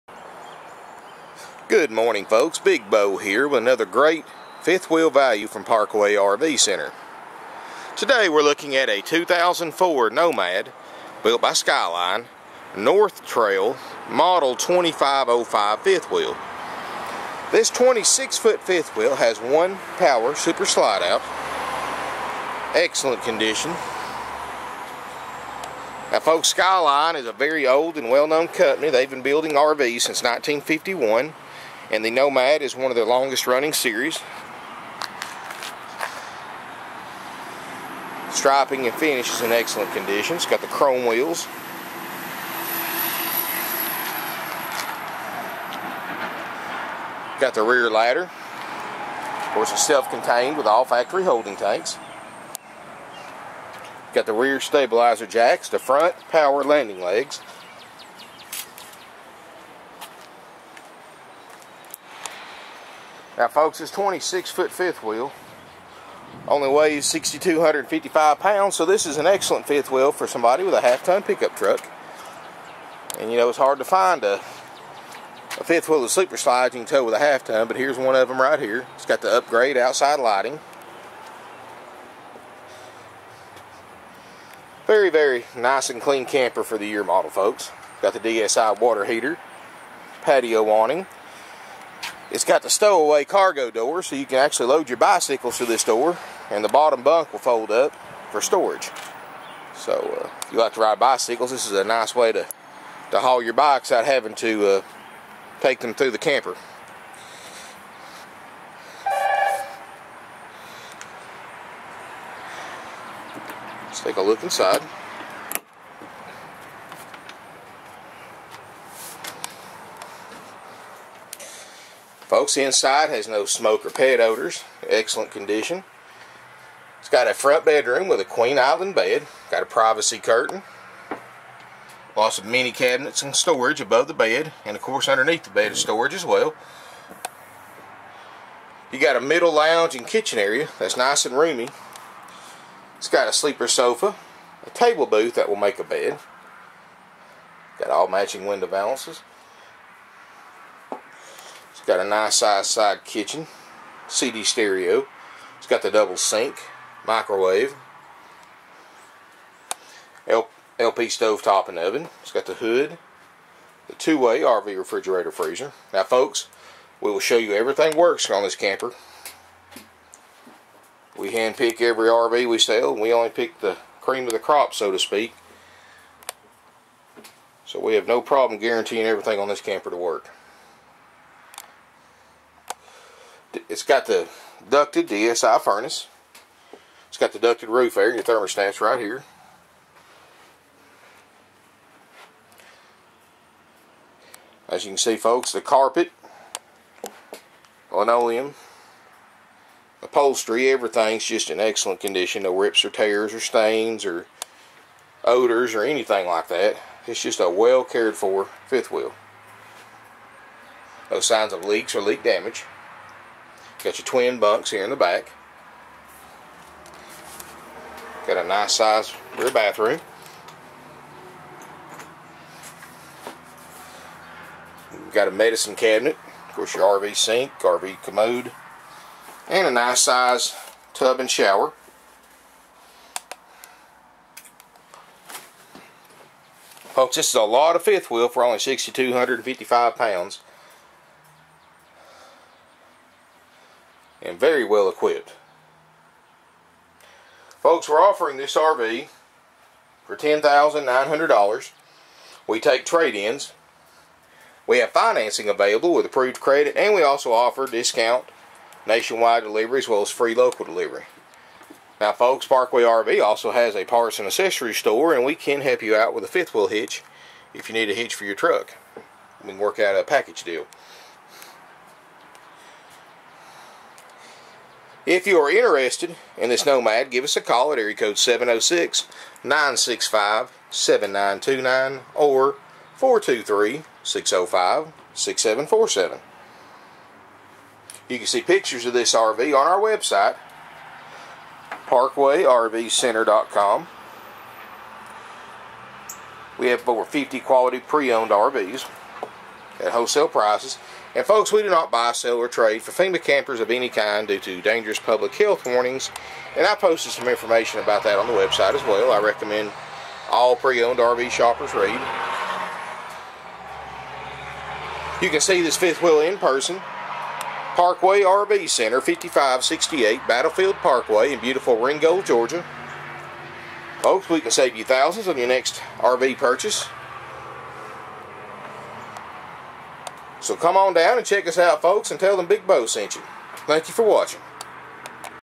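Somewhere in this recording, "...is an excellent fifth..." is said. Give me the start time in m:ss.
1:09.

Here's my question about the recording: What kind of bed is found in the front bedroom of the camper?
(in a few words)
queen island bed.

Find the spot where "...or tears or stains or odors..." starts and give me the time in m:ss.
3:22.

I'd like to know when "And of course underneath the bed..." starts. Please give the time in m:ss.
2:14.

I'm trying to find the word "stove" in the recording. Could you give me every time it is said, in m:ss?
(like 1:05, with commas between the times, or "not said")
2:41.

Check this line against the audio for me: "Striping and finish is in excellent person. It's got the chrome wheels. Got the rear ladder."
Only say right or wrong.
wrong.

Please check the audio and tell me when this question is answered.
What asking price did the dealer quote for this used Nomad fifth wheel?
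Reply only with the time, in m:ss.
4:10.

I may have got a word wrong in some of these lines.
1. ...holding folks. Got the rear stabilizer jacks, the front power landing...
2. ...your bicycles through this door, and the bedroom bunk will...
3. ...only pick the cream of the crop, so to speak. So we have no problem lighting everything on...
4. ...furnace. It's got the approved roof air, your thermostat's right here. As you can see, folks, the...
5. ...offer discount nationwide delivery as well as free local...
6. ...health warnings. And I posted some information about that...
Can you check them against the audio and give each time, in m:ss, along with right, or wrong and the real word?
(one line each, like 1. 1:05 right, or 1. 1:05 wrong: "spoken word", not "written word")
1. 0:51 wrong: "tanks", not "folks"
2. 1:34 wrong: "bottom", not "bedroom"
3. 2:53 wrong: "guaranteeing", not "lighting"
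4. 3:05 wrong: "ducted", not "approved"
5. 4:17 right
6. 5:05 right.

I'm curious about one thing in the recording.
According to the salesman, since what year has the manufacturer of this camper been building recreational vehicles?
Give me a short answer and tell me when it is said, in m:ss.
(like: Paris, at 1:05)
1951, at 0:30.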